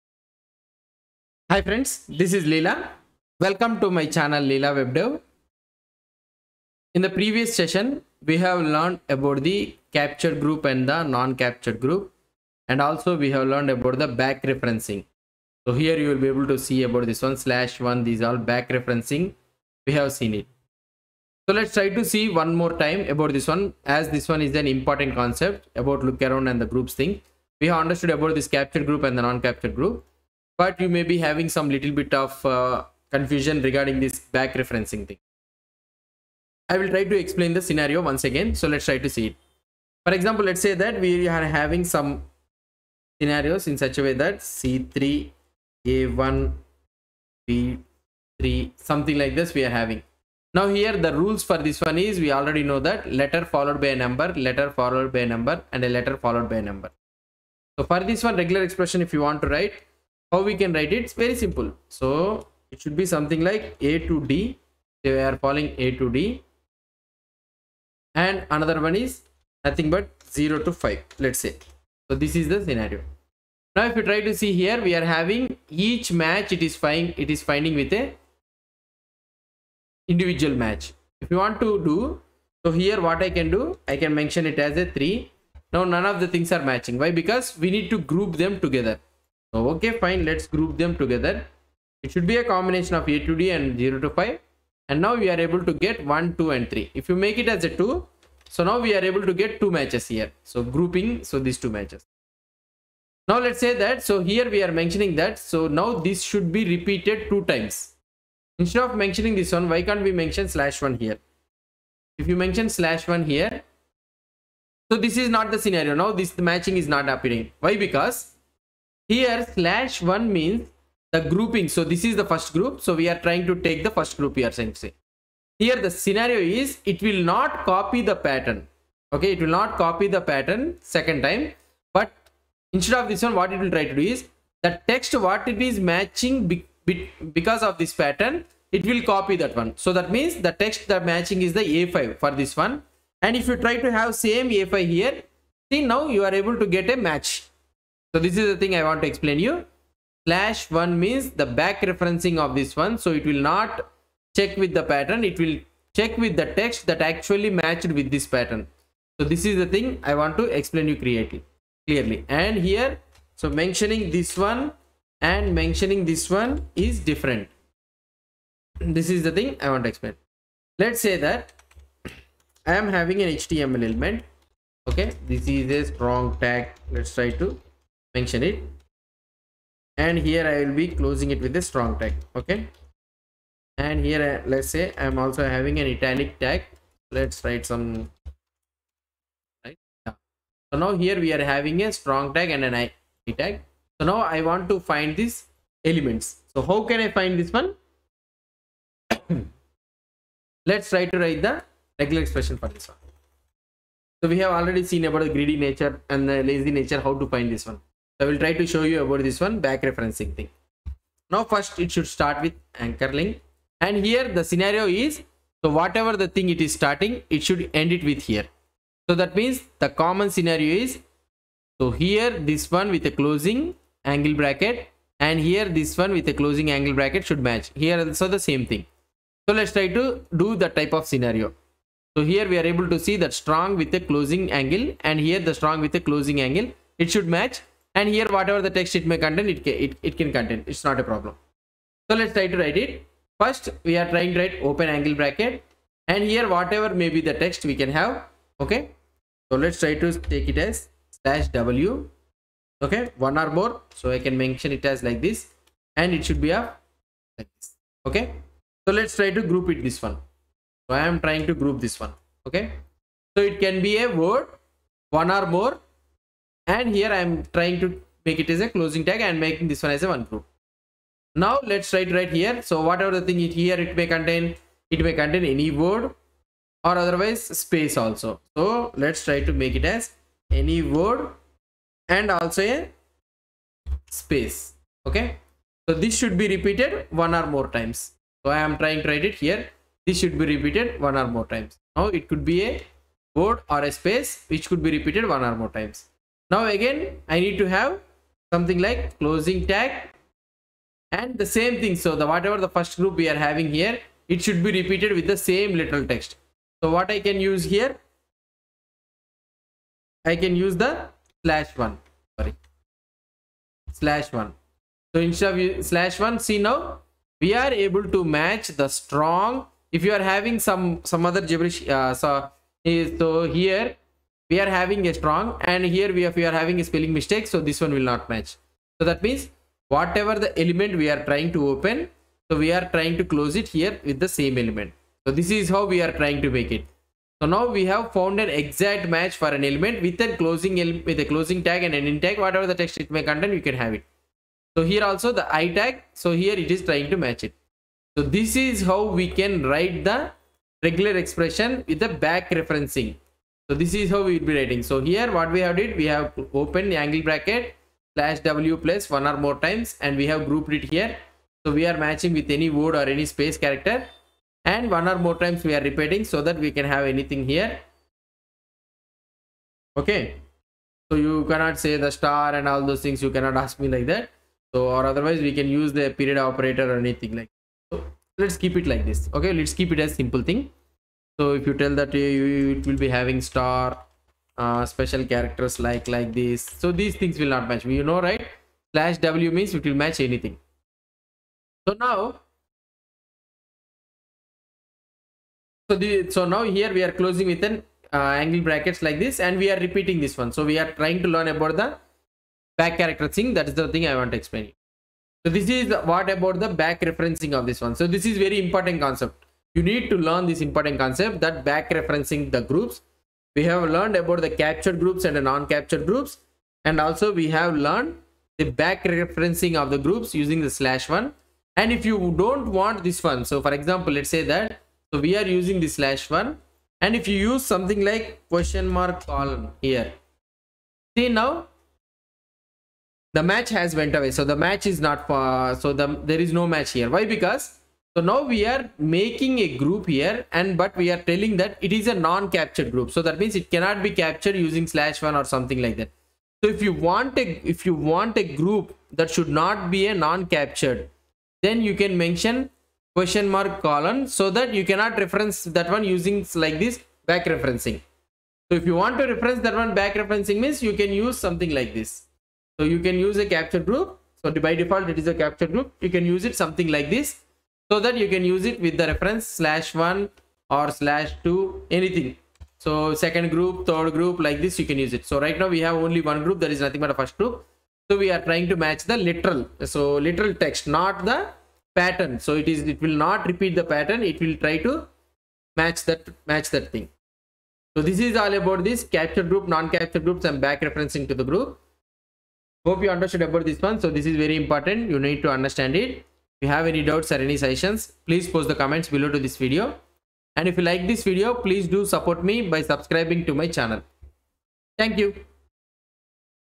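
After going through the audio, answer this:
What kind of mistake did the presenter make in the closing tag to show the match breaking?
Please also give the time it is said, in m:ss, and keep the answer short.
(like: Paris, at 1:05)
spelling mistake, at 5:26.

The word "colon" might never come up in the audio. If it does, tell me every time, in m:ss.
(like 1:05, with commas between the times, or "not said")
7:09, 7:33.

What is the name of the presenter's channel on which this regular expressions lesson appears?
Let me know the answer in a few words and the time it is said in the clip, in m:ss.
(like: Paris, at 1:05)
Leela WebDev, at 0:04.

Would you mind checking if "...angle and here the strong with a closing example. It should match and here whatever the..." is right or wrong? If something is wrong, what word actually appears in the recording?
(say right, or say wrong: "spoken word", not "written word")
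wrong: "angle", not "example".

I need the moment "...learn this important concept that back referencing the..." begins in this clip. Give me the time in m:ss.
6:50.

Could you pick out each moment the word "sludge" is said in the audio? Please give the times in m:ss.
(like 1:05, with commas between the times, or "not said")
not said.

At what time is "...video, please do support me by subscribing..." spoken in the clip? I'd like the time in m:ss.
8:21.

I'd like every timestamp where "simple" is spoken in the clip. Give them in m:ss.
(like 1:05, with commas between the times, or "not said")
1:01, 6:20.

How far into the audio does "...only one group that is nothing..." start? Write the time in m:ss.
7:56.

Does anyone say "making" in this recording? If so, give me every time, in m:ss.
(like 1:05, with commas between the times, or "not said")
4:29, 7:18.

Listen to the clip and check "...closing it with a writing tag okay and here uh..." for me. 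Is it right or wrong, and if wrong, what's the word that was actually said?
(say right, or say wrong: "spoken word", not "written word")
wrong: "strong", not "writing".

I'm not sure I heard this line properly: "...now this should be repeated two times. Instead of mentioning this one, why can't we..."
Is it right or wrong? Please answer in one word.
right.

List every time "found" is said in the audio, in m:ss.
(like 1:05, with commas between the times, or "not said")
5:38.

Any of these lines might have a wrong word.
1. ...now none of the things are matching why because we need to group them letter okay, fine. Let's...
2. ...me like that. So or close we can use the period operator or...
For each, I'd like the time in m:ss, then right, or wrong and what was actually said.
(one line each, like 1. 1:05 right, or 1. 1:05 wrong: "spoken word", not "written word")
1. 1:25 wrong: "together", not "letter"
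2. 6:13 wrong: "otherwise", not "close".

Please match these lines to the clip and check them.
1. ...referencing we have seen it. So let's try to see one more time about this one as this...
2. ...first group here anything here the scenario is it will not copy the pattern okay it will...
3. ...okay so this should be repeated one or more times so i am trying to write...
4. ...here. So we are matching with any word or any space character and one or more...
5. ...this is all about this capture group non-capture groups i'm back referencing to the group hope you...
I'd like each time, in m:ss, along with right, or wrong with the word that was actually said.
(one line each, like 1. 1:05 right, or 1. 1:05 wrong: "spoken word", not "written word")
1. 0:18 right
2. 2:03 wrong: "saying", not "anything"
3. 4:45 right
4. 6:00 right
5. 8:08 right.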